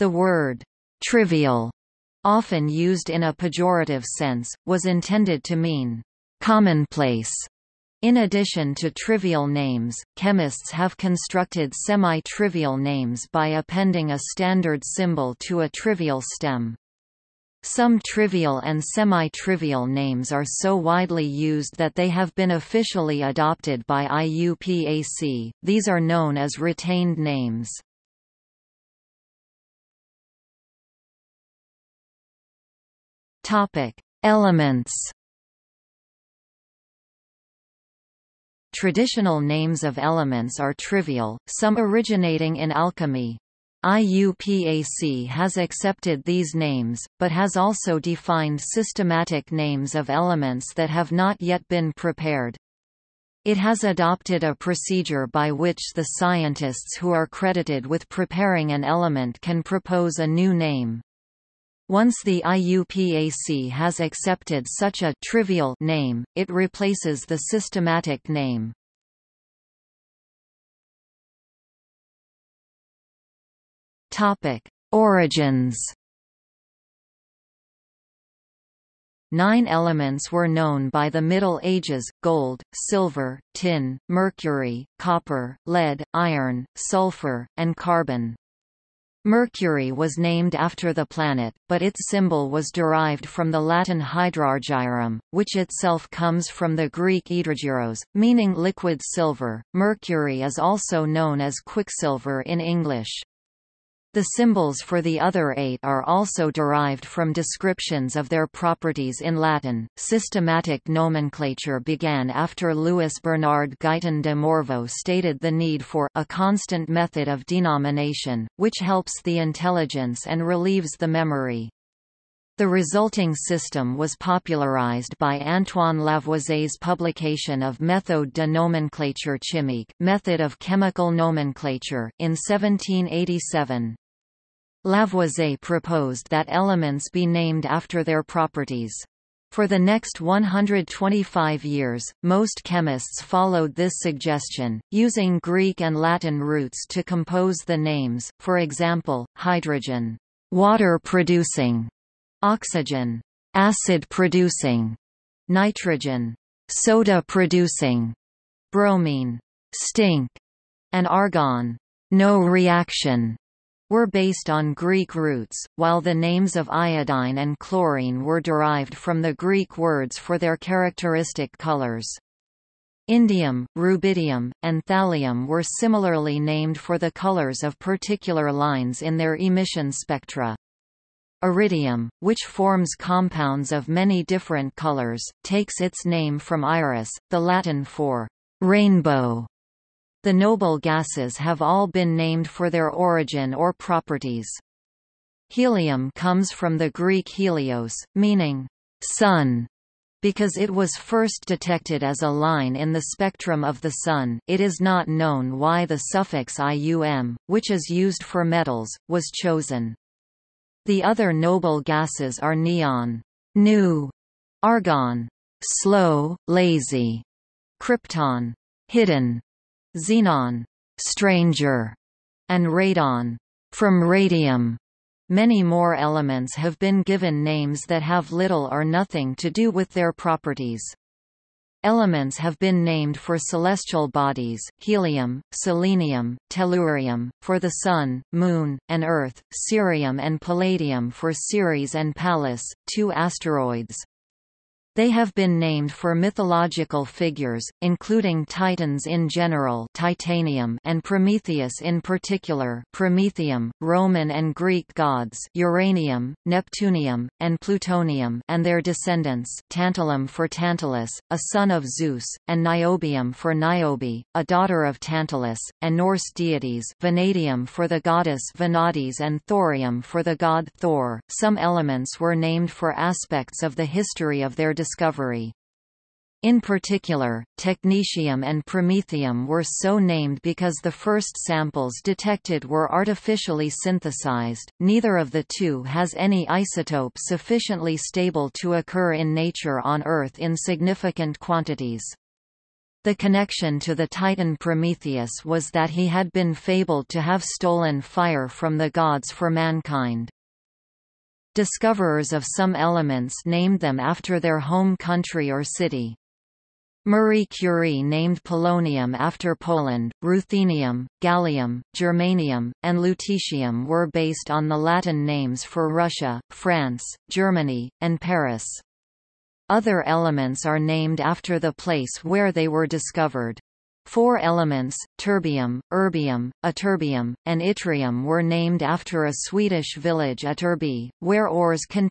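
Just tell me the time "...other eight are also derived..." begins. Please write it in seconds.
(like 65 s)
105 s.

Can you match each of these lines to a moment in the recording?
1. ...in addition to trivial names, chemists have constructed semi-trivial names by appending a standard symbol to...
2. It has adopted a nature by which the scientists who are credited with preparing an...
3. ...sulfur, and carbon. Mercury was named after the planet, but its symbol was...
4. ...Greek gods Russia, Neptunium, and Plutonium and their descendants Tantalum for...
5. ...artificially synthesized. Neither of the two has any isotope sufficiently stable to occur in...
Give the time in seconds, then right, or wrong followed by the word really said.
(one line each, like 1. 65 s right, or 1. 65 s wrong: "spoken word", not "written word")
1. 8 s right
2. 53 s wrong: "procedure", not "nature"
3. 86 s right
4. 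254 s wrong: "Uranium", not "Russia"
5. 282 s right.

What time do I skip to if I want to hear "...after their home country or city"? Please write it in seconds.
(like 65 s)
304 s.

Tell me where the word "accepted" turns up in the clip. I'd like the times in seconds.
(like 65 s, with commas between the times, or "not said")
45 s, 64 s.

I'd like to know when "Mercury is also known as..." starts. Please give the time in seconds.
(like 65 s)
99 s.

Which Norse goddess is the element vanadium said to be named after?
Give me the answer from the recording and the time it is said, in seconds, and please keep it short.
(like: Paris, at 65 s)
Vanadis, at 268 s.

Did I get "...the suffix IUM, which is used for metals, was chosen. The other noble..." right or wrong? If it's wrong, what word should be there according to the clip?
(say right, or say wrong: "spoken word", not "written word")
right.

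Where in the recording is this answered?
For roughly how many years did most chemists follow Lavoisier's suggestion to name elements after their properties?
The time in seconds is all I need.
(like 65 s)
140 s.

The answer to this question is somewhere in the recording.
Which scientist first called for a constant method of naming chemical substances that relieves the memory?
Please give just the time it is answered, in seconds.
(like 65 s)
112 s.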